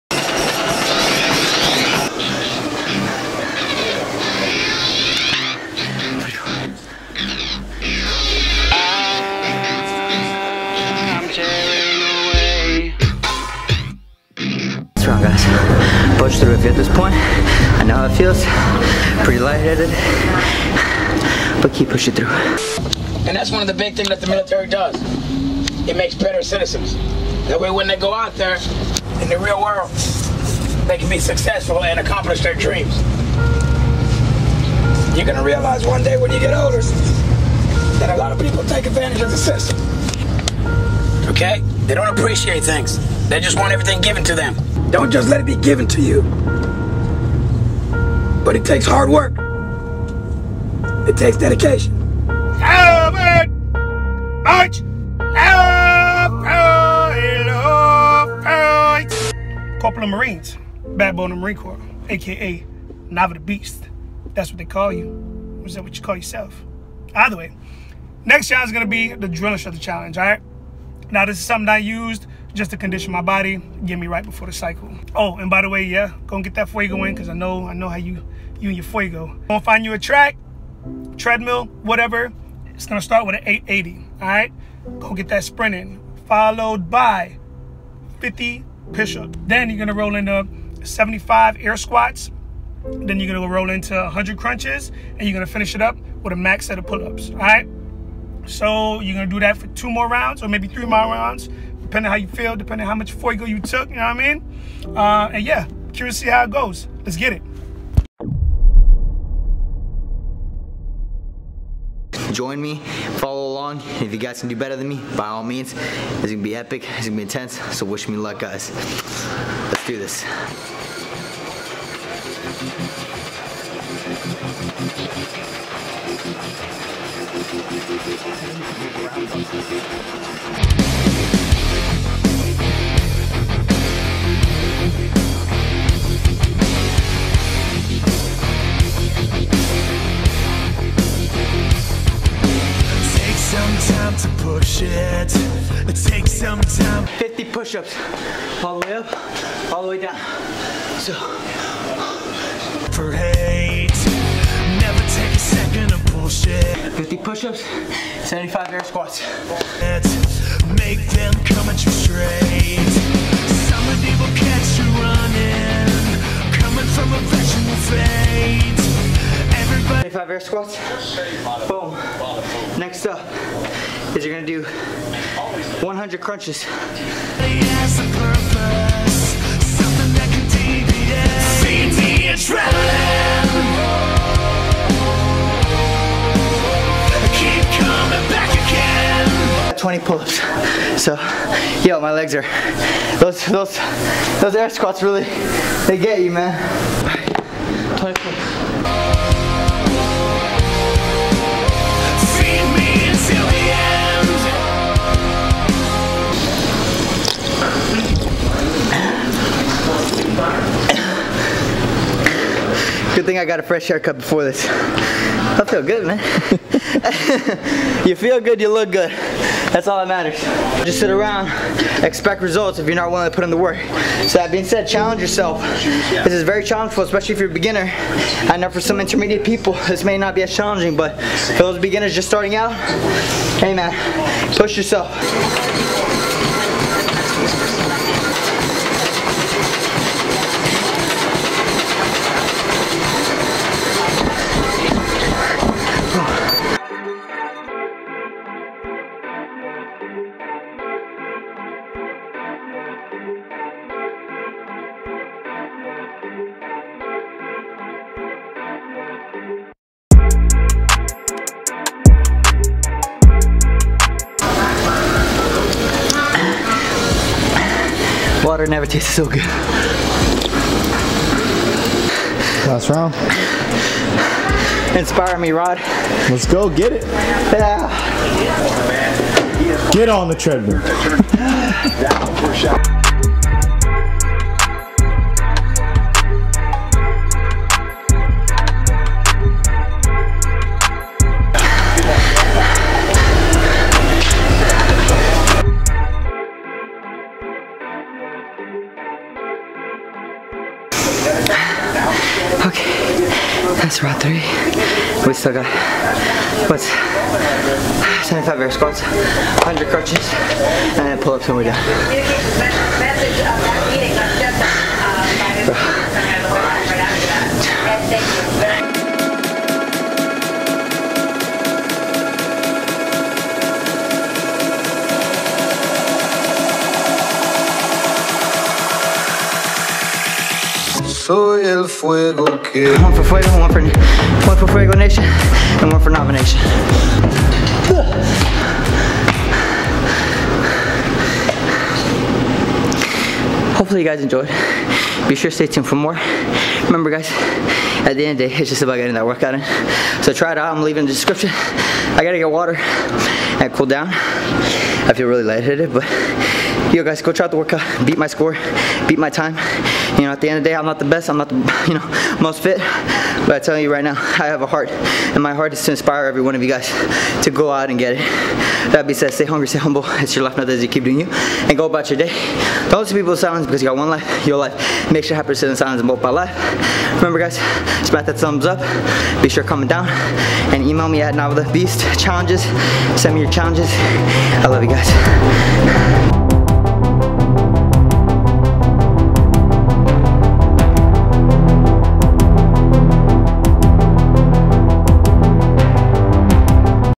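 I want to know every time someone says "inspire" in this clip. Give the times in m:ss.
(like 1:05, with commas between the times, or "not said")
4:34, 6:05.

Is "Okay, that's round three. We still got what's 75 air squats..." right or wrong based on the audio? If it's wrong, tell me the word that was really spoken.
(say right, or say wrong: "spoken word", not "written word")
right.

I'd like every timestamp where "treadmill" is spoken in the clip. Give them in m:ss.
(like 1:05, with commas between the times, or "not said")
1:21, 4:40.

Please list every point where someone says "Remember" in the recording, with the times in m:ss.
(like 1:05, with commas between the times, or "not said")
5:46, 6:17.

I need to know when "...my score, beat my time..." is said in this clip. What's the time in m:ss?
5:58.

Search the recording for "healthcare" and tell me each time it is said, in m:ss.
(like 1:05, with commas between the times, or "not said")
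not said.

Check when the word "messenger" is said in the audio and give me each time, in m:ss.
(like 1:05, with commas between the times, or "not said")
not said.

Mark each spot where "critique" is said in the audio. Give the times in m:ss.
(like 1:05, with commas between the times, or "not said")
not said.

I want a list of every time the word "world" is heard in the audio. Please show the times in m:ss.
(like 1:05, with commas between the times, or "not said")
0:29.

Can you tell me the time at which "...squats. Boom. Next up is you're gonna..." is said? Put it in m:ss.
2:50.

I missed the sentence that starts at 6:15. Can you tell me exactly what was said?
Make sure happy sit in silence and both life.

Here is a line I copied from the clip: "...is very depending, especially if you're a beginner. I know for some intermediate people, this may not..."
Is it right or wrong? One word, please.
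wrong.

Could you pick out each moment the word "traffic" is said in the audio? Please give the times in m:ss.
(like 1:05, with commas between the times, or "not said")
not said.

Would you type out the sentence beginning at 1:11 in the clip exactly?
Now, this is something I used just to condition my body, get me right before the cycle.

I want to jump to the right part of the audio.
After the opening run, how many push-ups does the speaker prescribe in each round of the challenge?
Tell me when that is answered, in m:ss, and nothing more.
1:28.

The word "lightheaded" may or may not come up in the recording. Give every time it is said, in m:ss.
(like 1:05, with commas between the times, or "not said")
0:19, 5:55.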